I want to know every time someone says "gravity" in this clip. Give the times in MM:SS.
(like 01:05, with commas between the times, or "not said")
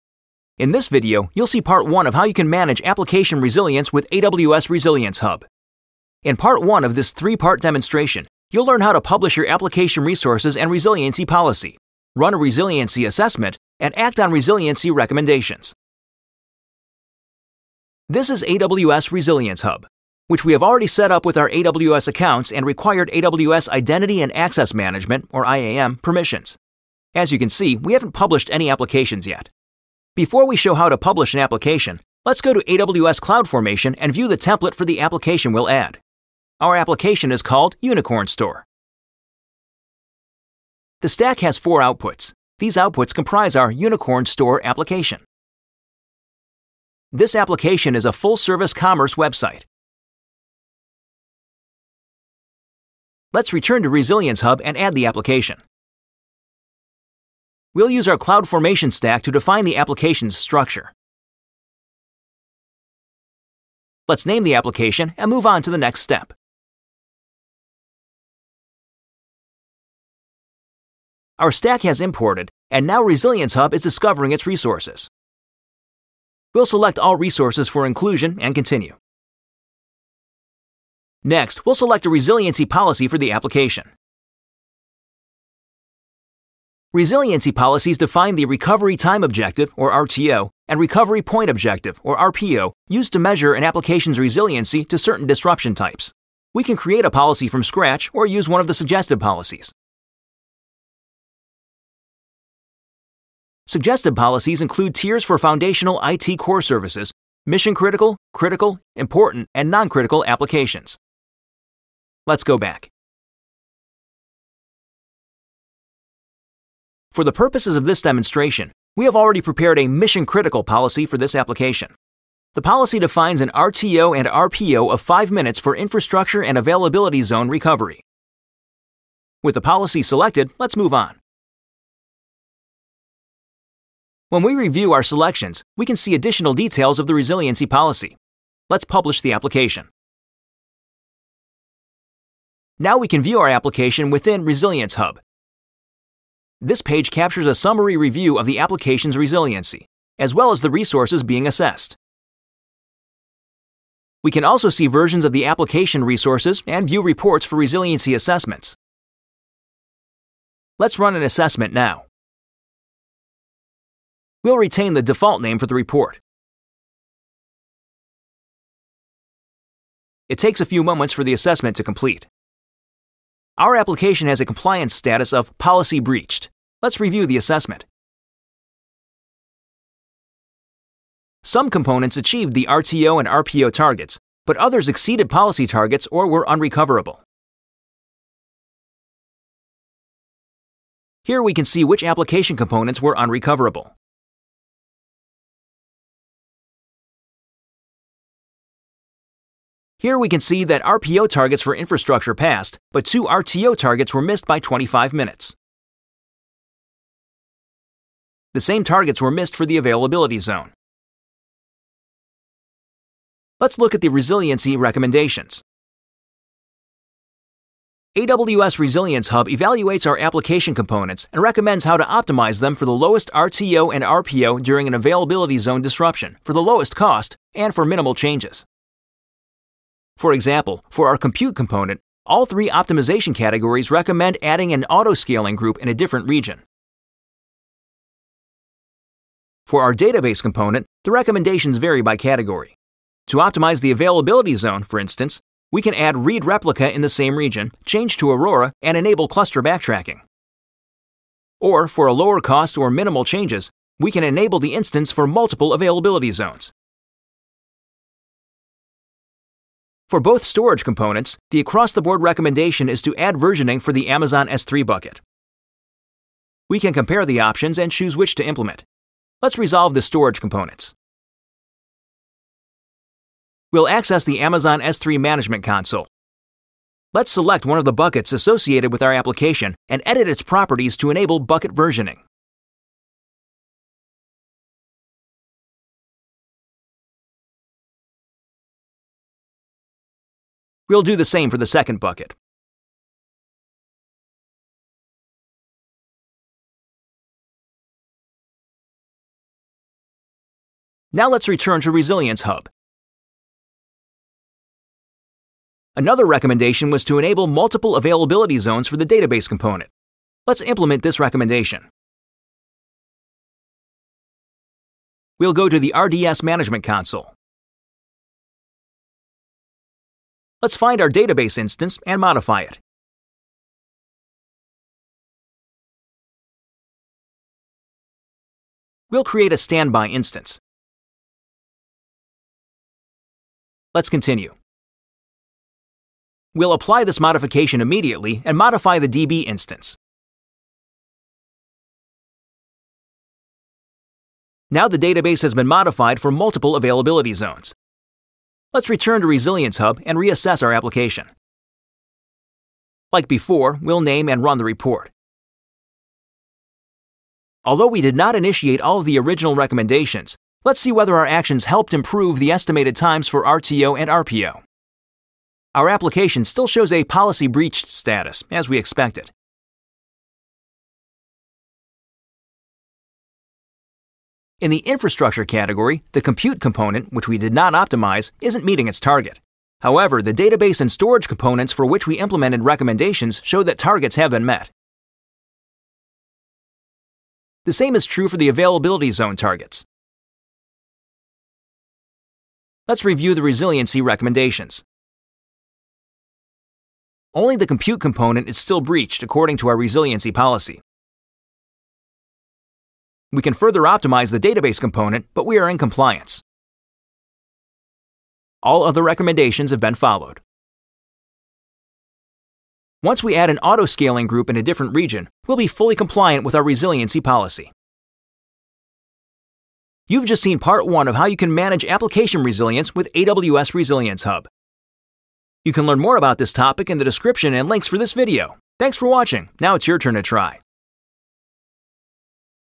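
not said.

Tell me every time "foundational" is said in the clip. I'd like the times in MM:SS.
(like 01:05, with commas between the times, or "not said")
01:45.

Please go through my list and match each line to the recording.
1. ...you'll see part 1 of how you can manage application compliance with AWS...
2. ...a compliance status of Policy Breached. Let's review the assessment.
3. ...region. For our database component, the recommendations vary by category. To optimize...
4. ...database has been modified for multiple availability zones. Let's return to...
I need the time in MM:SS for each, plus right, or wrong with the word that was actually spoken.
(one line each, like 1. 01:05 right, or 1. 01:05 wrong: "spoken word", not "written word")
1. 00:01 wrong: "resilience", not "compliance"
2. 02:54 right
3. 03:56 right
4. 05:44 right.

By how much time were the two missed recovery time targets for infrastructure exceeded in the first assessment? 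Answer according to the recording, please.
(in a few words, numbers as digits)
25 minutes.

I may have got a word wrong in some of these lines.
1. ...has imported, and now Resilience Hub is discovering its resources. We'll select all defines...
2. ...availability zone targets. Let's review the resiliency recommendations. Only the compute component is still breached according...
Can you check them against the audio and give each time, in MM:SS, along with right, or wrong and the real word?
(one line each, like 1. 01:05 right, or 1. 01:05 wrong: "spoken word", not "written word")
1. 01:11 wrong: "resources", not "defines"
2. 06:28 right.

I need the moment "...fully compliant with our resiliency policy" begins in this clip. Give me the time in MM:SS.
06:55.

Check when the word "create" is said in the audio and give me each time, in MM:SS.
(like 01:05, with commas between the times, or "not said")
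01:36, 05:29.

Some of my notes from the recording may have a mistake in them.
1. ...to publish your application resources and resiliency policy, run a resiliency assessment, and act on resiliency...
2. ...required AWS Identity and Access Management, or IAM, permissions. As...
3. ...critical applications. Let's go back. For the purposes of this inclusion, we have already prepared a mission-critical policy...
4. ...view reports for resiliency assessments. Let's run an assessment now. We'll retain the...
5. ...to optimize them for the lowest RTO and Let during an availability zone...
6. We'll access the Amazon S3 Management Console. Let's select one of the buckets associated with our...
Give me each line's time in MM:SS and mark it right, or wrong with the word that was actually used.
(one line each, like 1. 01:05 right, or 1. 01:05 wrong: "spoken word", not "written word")
1. 00:08 right
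2. 00:22 right
3. 01:49 wrong: "demonstration", not "inclusion"
4. 02:36 right
5. 03:41 wrong: "RPO", not "Let"
6. 04:33 right.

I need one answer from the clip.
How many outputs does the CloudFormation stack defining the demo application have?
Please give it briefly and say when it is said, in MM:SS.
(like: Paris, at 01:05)
4, at 00:41.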